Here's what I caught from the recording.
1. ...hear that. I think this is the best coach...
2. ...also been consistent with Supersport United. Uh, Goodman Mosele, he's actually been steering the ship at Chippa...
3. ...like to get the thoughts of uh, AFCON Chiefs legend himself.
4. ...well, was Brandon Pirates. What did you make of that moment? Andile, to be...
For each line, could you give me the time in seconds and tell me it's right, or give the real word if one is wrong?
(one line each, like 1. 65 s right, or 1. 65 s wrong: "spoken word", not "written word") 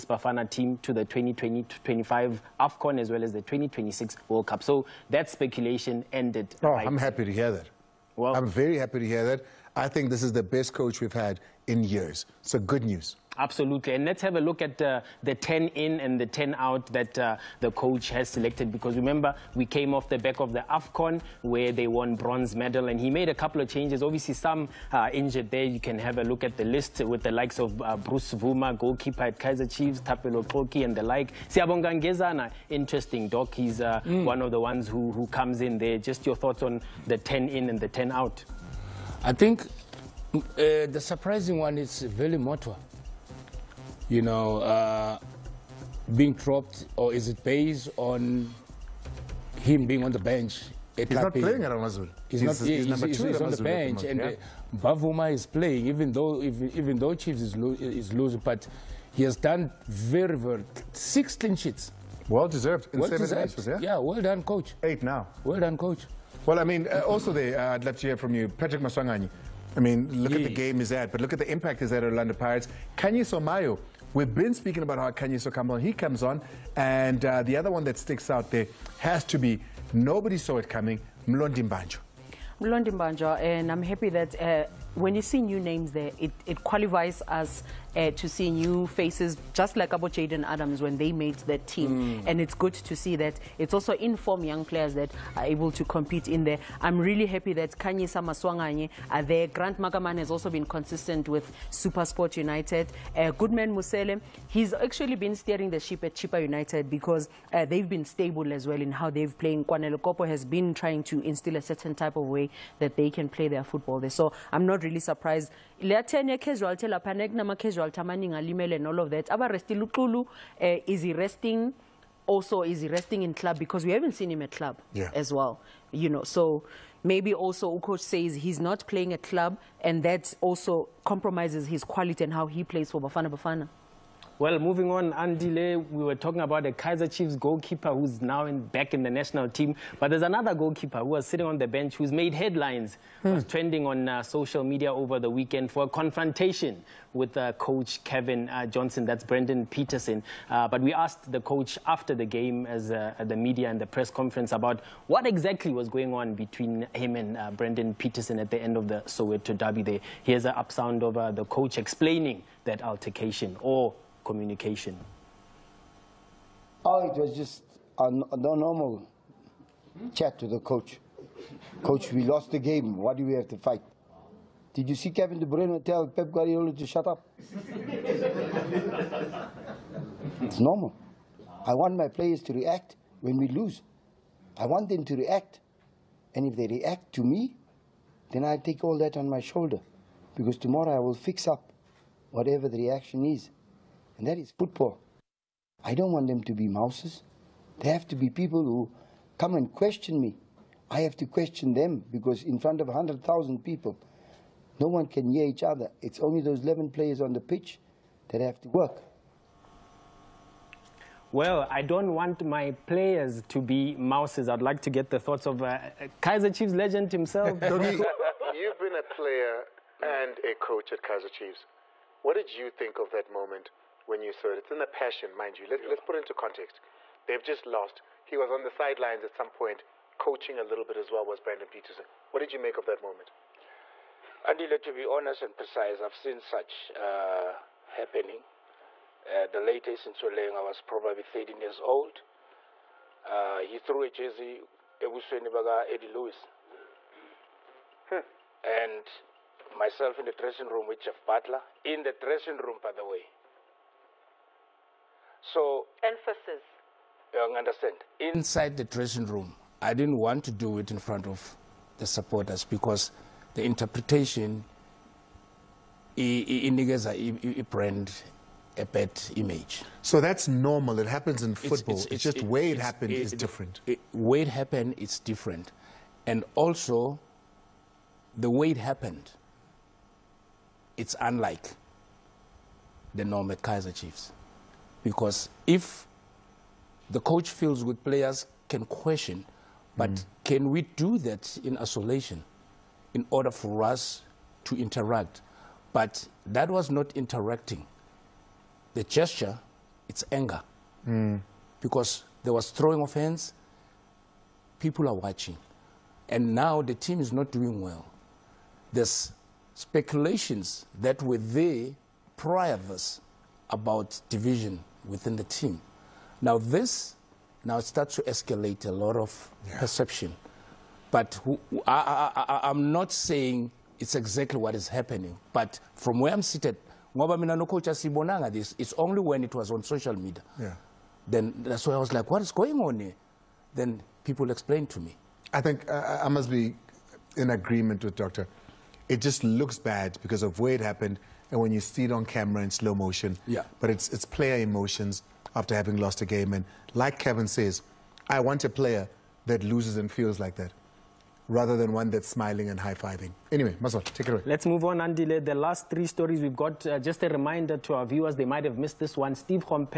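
1. 9 s right
2. 100 s right
3. 214 s wrong: "Kaizer", not "AFCON"
4. 231 s wrong: "Peterson", not "Pirates".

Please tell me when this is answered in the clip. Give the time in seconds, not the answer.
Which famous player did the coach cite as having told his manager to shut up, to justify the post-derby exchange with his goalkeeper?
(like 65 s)
175 s.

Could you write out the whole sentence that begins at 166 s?
Oh, it was just a, normal chat to the coach.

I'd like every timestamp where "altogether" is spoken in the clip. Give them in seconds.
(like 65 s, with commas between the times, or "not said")
not said.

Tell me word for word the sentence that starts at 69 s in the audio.
I mean, look at the game he's at, but look at the impact he's had at Orlando Pirates.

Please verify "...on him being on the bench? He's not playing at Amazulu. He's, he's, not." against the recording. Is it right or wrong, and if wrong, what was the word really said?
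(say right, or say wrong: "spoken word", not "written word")
right.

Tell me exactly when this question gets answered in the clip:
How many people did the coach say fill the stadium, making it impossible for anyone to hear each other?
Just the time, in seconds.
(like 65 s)
202 s.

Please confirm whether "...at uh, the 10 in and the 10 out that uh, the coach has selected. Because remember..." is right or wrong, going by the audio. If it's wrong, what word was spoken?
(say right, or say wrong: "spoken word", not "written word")
right.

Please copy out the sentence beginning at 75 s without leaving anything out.
He comes on, and uh, the other one that sticks out there has to be nobody saw it coming, Mlondi Mbanjwa.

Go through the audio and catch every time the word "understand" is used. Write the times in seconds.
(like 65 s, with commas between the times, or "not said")
257 s.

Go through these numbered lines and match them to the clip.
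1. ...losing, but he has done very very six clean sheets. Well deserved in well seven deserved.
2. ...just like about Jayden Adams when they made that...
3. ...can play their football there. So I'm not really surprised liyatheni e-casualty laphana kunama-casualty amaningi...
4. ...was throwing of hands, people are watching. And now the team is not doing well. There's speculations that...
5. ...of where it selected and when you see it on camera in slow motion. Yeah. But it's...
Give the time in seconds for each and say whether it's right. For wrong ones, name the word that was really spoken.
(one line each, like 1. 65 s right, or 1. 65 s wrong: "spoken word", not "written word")
1. 58 s right
2. 89 s right
3. 113 s right
4. 302 s right
5. 340 s wrong: "happened", not "selected".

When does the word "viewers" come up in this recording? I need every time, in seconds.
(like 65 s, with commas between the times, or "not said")
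358 s.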